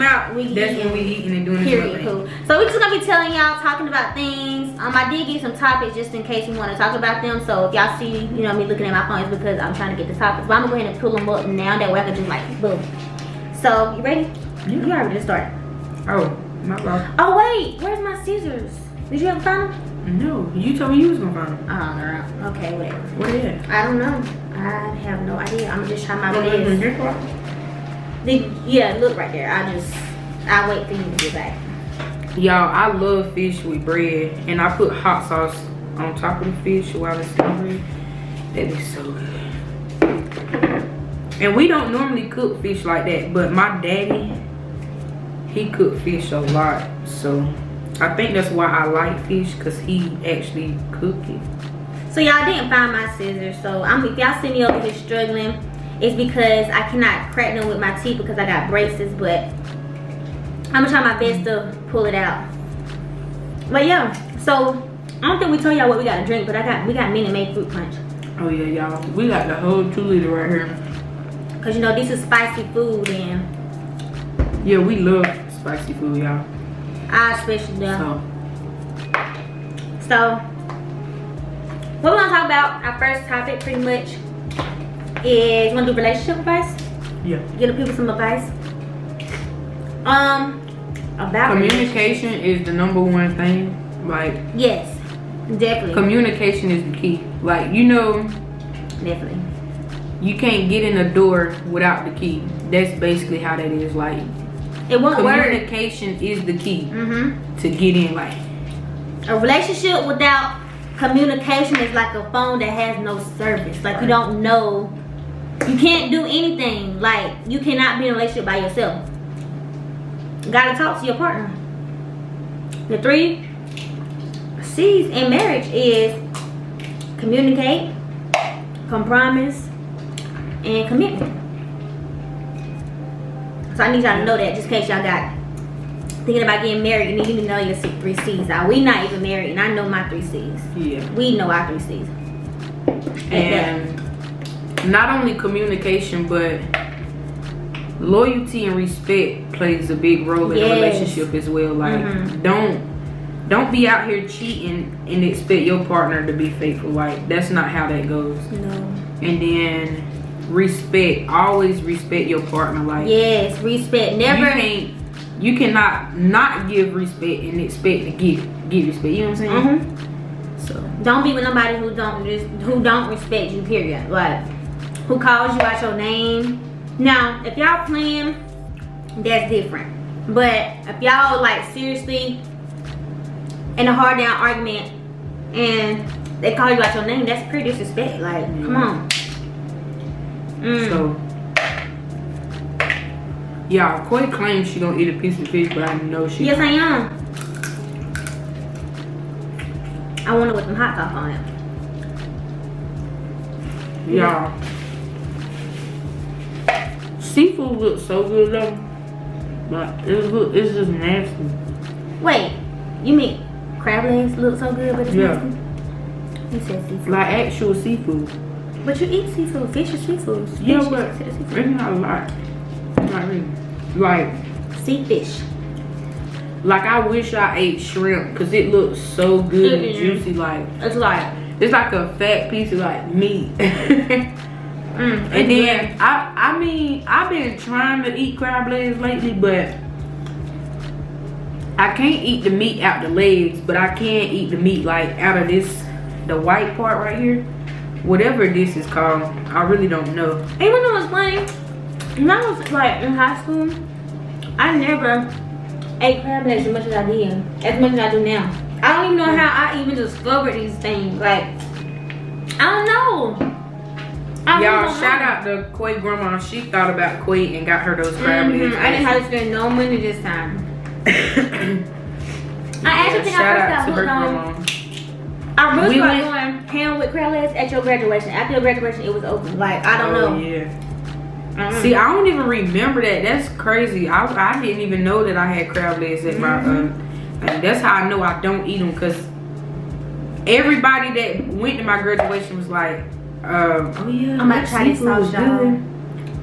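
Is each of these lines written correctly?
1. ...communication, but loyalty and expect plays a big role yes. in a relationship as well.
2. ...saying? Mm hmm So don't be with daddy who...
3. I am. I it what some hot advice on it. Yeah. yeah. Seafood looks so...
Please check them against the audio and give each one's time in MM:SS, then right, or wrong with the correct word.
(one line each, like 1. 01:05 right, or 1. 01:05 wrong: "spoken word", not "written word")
1. 02:25 wrong: "respect", not "expect"
2. 02:49 wrong: "nobody", not "daddy"
3. 03:16 wrong: "sauce", not "advice".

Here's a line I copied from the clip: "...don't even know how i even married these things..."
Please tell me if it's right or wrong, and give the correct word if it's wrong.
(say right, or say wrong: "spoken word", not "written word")
wrong: "discovered", not "married".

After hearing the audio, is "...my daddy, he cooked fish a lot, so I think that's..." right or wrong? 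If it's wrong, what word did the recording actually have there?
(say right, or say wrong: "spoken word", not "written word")
right.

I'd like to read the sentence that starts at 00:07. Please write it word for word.
So if y'all see, you know, me looking at my phone, it's because I'm trying to get the topics.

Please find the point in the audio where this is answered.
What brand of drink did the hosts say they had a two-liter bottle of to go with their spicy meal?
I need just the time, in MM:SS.
01:07.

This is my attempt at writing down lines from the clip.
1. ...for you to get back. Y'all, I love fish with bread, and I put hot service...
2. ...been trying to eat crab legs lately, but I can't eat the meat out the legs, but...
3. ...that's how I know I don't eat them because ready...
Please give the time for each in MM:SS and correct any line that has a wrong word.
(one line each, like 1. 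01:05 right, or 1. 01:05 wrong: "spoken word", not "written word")
1. 00:30 wrong: "sauce", not "service"
2. 03:57 right
3. 04:47 wrong: "everybody", not "ready".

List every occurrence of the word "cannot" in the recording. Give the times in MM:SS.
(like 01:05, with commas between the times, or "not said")
00:56, 01:57, 02:45.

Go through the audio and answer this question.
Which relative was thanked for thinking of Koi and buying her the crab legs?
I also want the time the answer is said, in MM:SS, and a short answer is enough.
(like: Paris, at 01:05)
Koi's grandma, at 04:25.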